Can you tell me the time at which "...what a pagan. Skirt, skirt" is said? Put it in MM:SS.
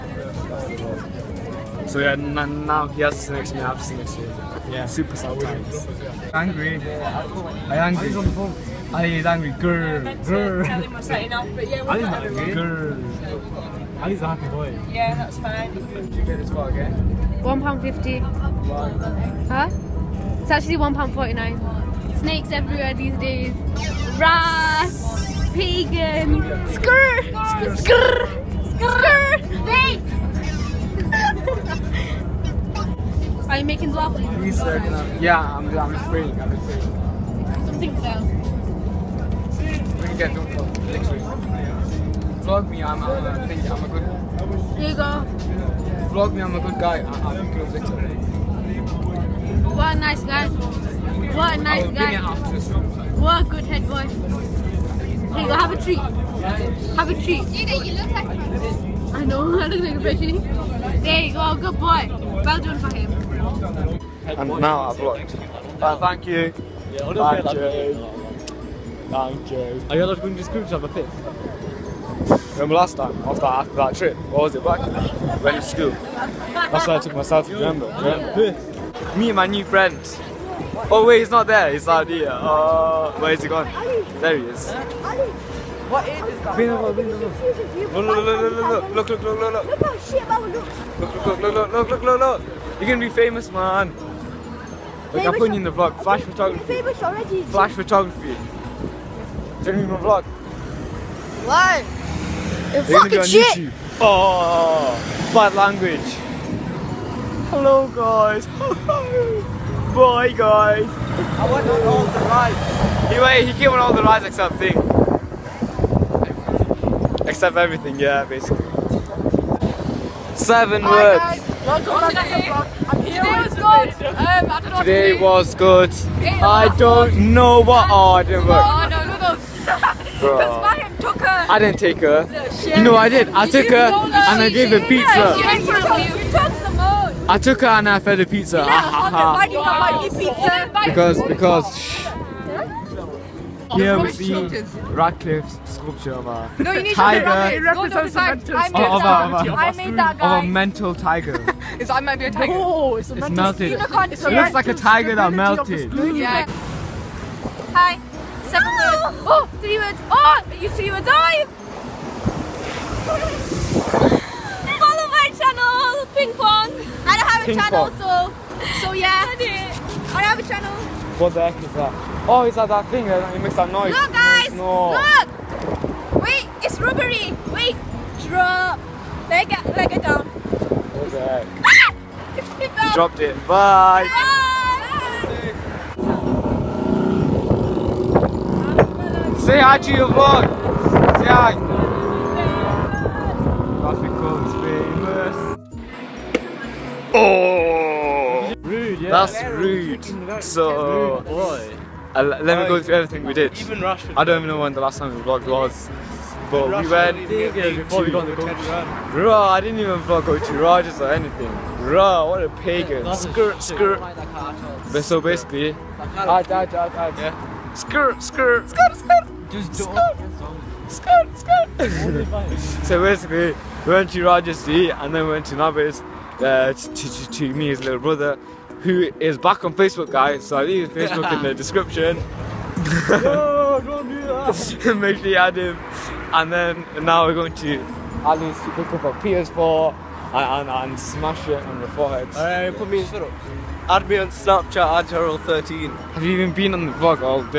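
03:32.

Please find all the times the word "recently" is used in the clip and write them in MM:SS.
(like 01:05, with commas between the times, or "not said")
not said.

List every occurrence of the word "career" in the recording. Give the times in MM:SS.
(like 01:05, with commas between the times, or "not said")
not said.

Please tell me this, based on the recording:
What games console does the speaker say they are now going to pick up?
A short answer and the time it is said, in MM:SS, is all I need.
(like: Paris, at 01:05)
PS4, at 03:59.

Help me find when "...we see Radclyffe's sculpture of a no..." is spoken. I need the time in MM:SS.
02:23.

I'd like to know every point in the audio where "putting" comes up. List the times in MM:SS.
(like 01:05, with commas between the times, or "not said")
01:35.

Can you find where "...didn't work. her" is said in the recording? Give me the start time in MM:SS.
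02:08.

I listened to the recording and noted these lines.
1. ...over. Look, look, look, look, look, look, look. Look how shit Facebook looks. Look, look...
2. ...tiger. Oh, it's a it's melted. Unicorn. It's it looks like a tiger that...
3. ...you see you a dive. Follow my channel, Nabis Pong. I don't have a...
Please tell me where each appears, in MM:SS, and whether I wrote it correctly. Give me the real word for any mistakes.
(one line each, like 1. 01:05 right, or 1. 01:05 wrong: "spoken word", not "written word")
1. 01:27 wrong: "Baba", not "Facebook"
2. 02:32 right
3. 02:40 wrong: "Ping", not "Nabis".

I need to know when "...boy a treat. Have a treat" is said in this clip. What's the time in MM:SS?
00:53.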